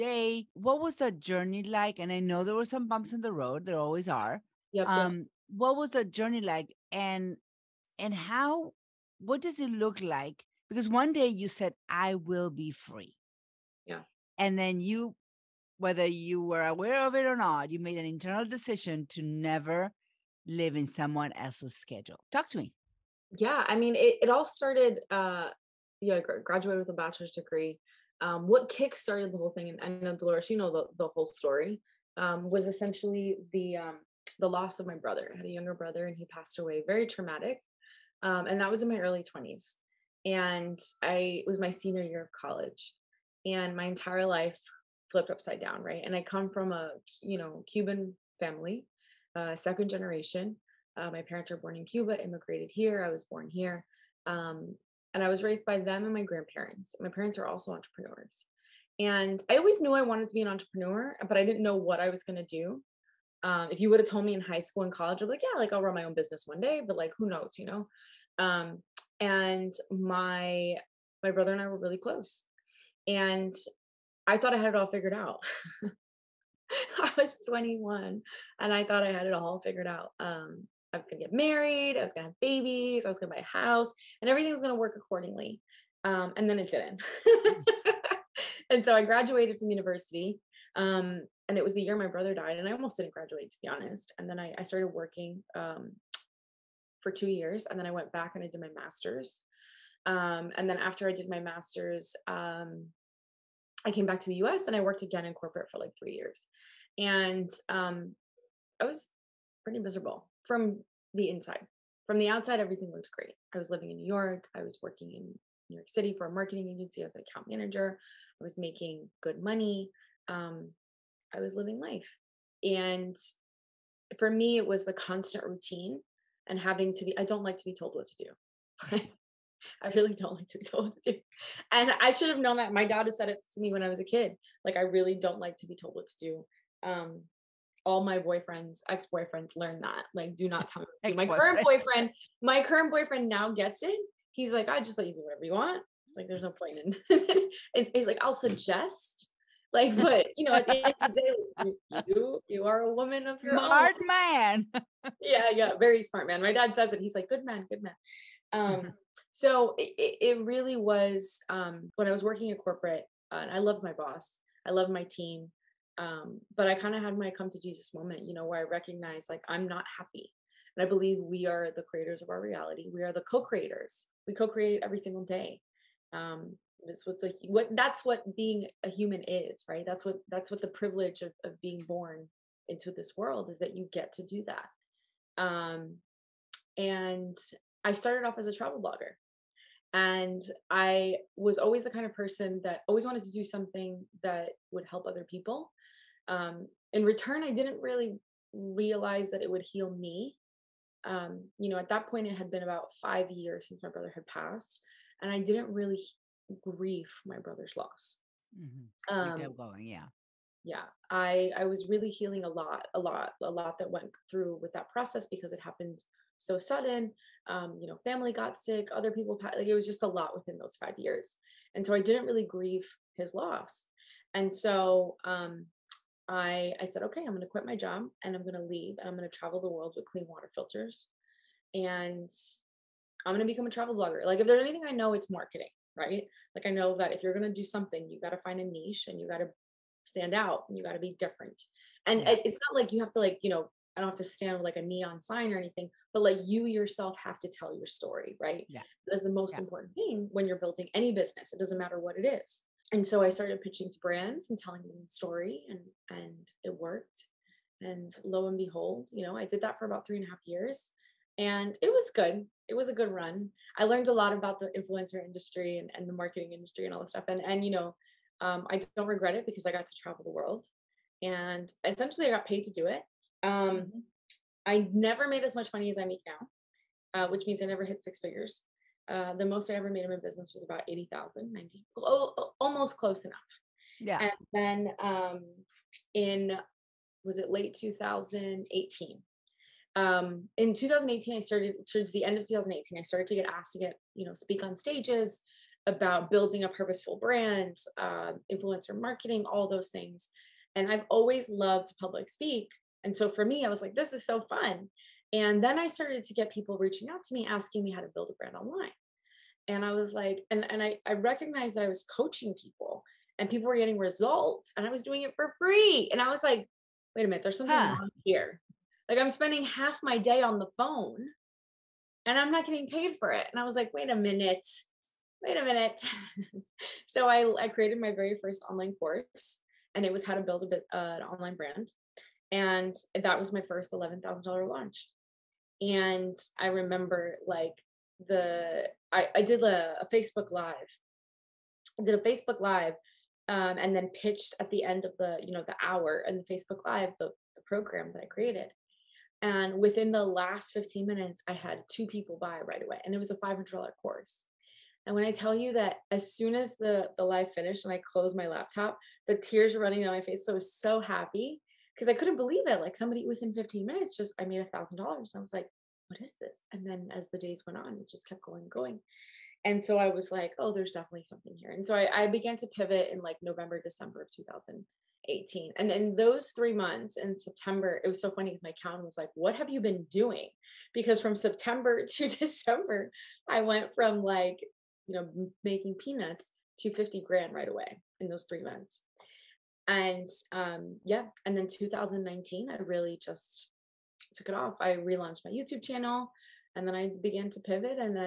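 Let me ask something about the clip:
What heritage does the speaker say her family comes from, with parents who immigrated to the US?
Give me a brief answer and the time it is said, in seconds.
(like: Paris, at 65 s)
Cuban, at 47 s.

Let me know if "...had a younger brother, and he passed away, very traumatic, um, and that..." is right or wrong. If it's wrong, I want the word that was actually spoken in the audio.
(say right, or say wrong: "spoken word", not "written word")
right.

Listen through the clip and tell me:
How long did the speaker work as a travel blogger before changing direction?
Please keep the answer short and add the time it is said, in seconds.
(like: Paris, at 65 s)
3.5 years, at 260 s.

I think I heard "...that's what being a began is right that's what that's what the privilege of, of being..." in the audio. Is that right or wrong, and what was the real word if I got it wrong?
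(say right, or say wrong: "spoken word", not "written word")
wrong: "human", not "began".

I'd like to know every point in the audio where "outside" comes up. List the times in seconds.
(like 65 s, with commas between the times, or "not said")
112 s.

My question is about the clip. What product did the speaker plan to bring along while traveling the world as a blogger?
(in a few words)
Clean water filters.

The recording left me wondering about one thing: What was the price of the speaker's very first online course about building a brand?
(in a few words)
$500.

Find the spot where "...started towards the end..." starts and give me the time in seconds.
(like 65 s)
291 s.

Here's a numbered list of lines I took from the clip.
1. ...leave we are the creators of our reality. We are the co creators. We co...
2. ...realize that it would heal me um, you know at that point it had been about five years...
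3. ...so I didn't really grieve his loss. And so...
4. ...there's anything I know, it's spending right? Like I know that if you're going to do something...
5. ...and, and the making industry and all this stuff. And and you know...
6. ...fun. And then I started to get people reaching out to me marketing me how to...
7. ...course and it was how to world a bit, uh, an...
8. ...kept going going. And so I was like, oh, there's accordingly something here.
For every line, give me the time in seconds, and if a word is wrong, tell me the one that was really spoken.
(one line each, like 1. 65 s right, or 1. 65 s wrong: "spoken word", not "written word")
1. 170 s wrong: "believe", not "leave"
2. 198 s right
3. 221 s right
4. 234 s wrong: "marketing", not "spending"
5. 265 s wrong: "marketing", not "making"
6. 304 s wrong: "asking", not "marketing"
7. 328 s wrong: "build", not "world"
8. 368 s wrong: "definitely", not "accordingly".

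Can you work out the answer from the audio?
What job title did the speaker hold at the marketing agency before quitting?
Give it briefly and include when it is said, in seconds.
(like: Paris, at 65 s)
Account manager, at 117 s.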